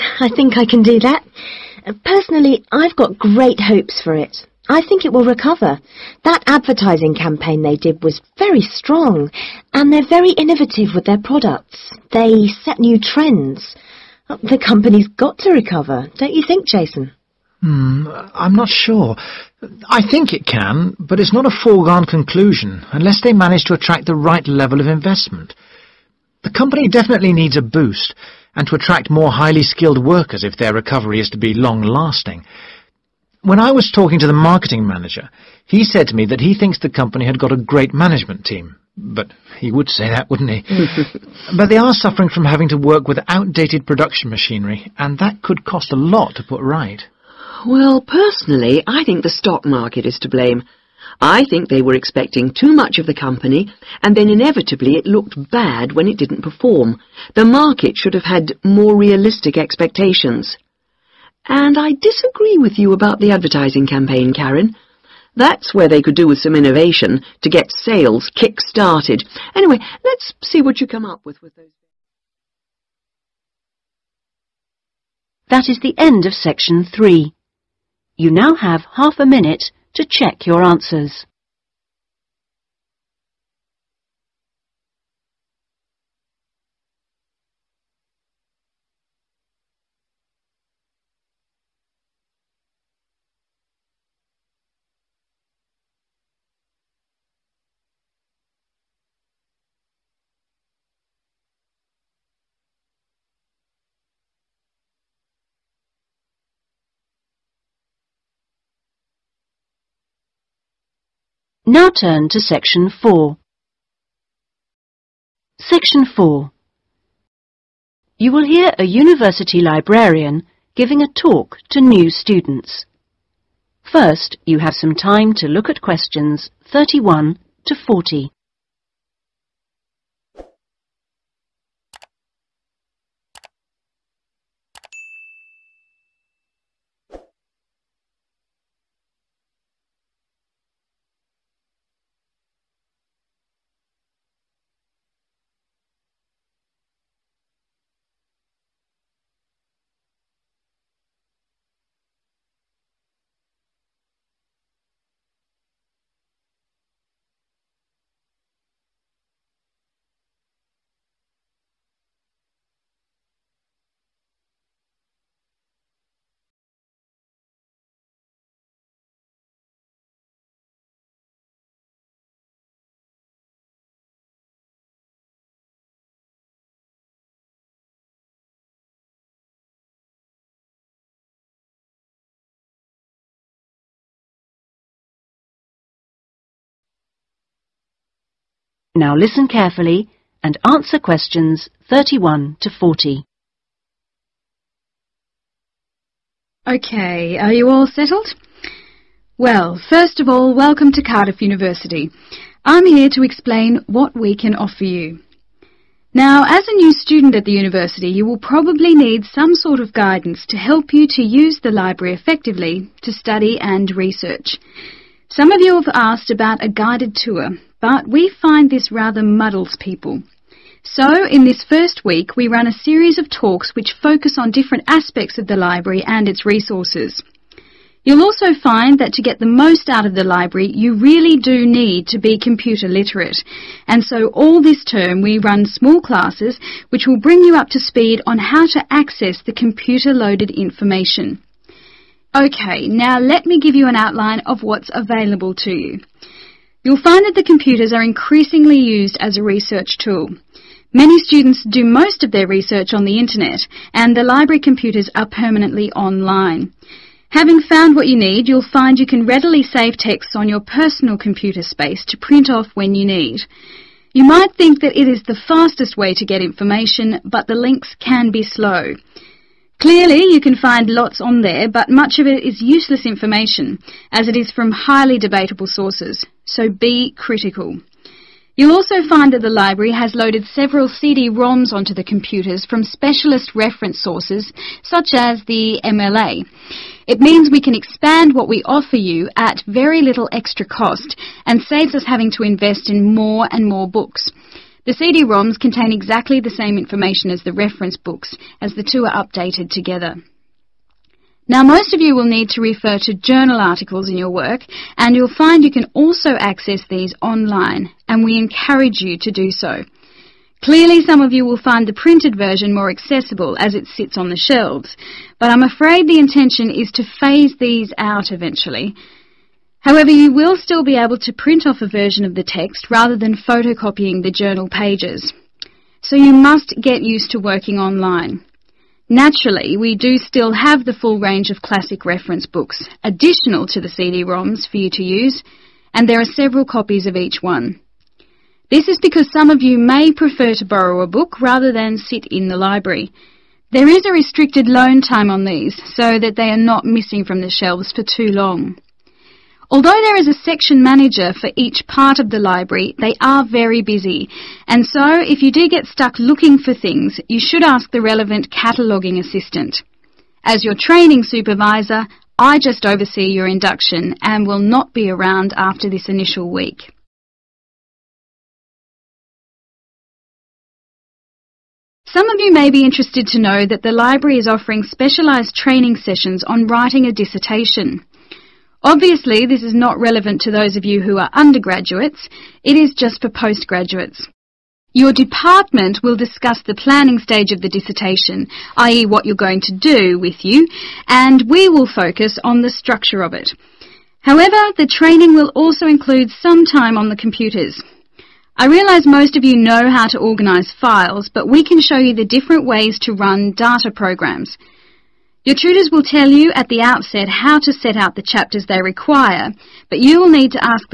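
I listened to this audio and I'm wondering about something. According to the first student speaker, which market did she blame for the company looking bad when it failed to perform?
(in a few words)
the stock market.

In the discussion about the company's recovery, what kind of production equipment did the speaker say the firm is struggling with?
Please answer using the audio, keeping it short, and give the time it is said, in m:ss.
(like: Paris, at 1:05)
outdated production machinery, at 0:43.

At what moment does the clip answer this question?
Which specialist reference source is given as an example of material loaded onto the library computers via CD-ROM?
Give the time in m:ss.
4:45.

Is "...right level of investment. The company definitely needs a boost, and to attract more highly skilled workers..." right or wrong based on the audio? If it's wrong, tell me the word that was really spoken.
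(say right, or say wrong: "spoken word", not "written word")
right.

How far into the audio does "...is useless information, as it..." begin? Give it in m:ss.
4:32.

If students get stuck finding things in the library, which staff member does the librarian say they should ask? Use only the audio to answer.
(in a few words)
cataloguing assistant.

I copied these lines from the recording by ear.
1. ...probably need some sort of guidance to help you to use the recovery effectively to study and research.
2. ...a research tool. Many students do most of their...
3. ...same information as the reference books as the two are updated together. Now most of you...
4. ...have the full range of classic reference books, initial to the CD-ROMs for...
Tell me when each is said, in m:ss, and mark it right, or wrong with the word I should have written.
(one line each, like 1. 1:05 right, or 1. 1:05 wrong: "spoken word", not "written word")
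1. 3:28 wrong: "library", not "recovery"
2. 4:09 right
3. 4:56 right
4. 5:30 wrong: "additional", not "initial".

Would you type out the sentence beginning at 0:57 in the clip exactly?
The market should have had more realistic expectations.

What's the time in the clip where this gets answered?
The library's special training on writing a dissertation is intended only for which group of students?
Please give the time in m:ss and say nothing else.
6:23.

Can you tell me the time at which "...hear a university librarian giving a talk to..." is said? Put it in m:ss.
1:58.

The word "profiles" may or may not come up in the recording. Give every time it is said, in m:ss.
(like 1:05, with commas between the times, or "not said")
not said.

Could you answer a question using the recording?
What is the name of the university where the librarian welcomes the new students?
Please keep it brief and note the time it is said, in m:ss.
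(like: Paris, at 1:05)
Cardiff University, at 3:21.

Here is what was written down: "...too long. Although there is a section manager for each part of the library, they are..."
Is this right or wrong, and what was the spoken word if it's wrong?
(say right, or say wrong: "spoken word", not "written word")
right.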